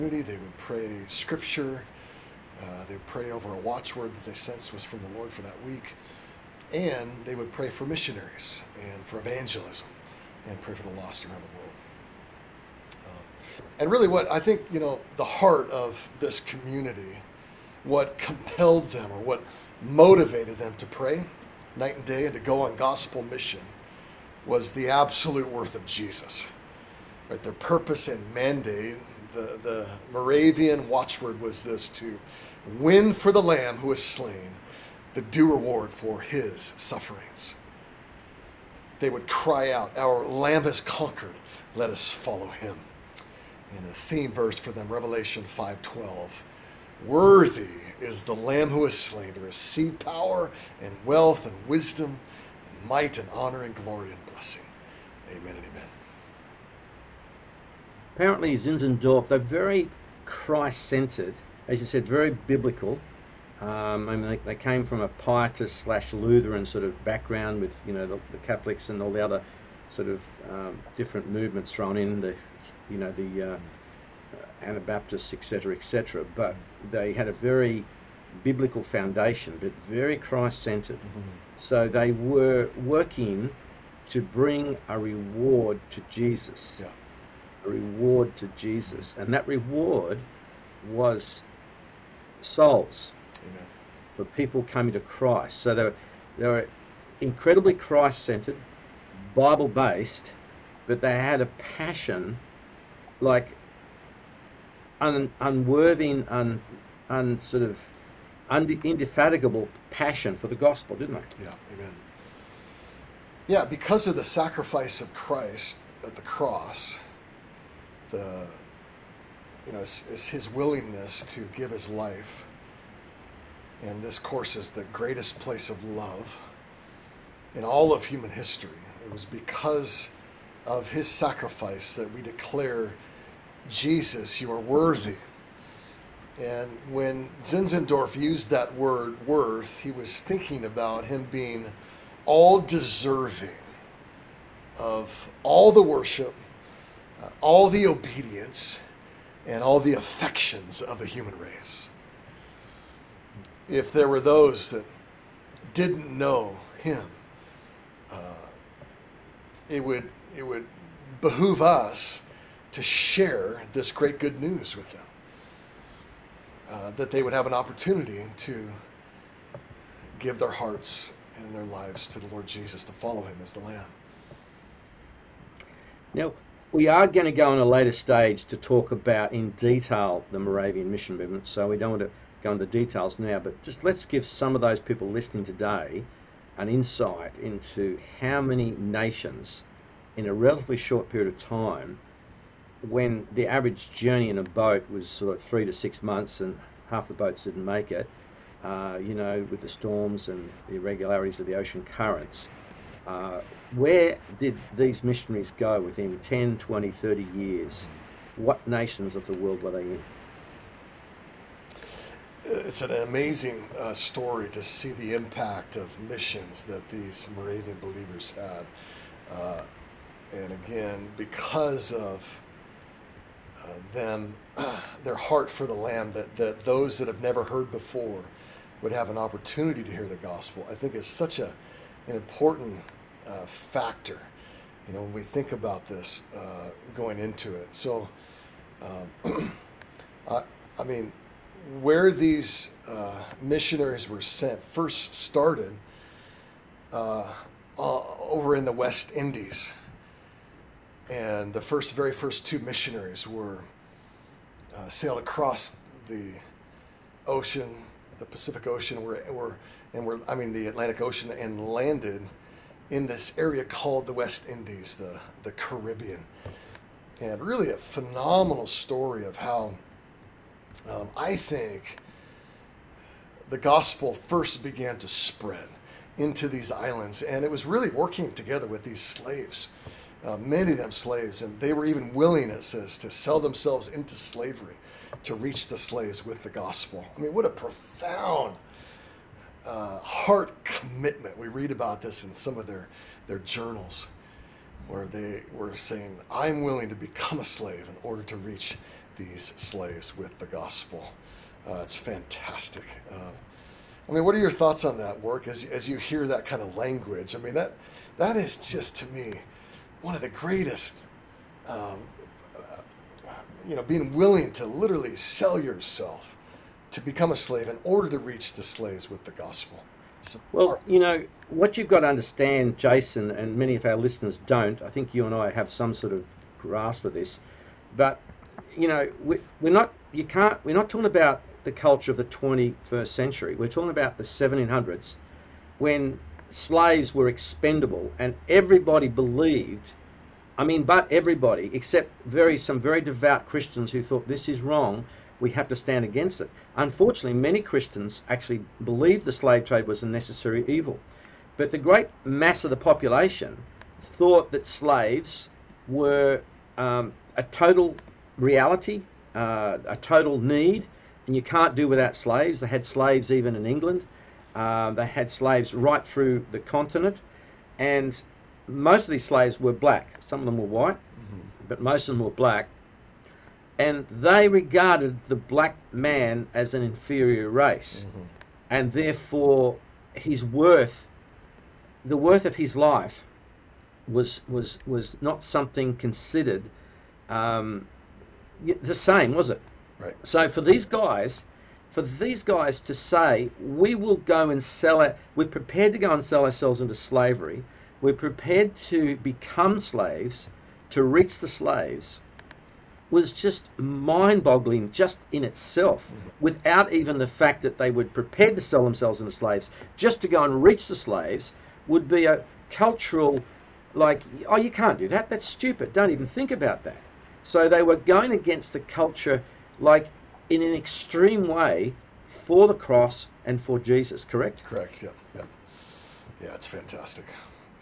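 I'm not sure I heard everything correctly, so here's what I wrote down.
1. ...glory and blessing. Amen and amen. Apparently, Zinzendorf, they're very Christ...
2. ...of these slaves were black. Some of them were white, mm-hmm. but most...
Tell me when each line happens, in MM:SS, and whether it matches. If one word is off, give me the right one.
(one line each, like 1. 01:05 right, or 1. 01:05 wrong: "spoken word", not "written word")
1. 00:53 right
2. 06:09 right.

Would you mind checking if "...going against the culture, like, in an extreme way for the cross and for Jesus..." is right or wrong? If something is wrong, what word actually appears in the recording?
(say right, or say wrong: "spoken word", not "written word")
right.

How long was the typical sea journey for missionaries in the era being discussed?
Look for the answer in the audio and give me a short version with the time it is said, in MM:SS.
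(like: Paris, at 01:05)
3 to 6 months, at 03:15.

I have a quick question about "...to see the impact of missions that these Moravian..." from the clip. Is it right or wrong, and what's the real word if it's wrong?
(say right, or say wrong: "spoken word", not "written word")
right.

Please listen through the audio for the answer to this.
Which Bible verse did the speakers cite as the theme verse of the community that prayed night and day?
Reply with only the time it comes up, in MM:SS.
00:44.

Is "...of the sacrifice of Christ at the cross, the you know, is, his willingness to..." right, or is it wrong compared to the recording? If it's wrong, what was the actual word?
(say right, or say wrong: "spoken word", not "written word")
right.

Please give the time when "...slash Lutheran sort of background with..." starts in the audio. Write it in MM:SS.
01:05.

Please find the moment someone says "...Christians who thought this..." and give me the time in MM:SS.
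05:43.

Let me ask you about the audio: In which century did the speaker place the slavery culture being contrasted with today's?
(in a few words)
1700s.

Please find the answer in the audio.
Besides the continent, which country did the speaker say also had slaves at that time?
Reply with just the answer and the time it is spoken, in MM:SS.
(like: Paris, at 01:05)
England, at 06:03.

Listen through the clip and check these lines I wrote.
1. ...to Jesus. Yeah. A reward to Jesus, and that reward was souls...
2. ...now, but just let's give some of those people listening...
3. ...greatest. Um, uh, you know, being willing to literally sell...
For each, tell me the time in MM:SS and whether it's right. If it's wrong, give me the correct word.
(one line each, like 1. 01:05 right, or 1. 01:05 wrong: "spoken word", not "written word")
1. 01:25 right
2. 03:03 right
3. 05:10 right.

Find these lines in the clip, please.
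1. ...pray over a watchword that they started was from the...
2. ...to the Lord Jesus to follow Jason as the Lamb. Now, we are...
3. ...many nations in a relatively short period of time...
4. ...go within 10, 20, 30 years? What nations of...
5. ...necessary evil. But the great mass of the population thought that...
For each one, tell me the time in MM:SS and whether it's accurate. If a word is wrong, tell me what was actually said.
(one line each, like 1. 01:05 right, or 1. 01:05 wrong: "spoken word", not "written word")
1. 00:03 wrong: "sensed", not "started"
2. 02:52 wrong: "Him", not "Jason"
3. 03:08 right
4. 03:25 right
5. 05:50 right.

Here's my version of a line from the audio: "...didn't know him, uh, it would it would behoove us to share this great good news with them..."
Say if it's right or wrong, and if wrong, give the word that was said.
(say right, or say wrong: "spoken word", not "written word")
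right.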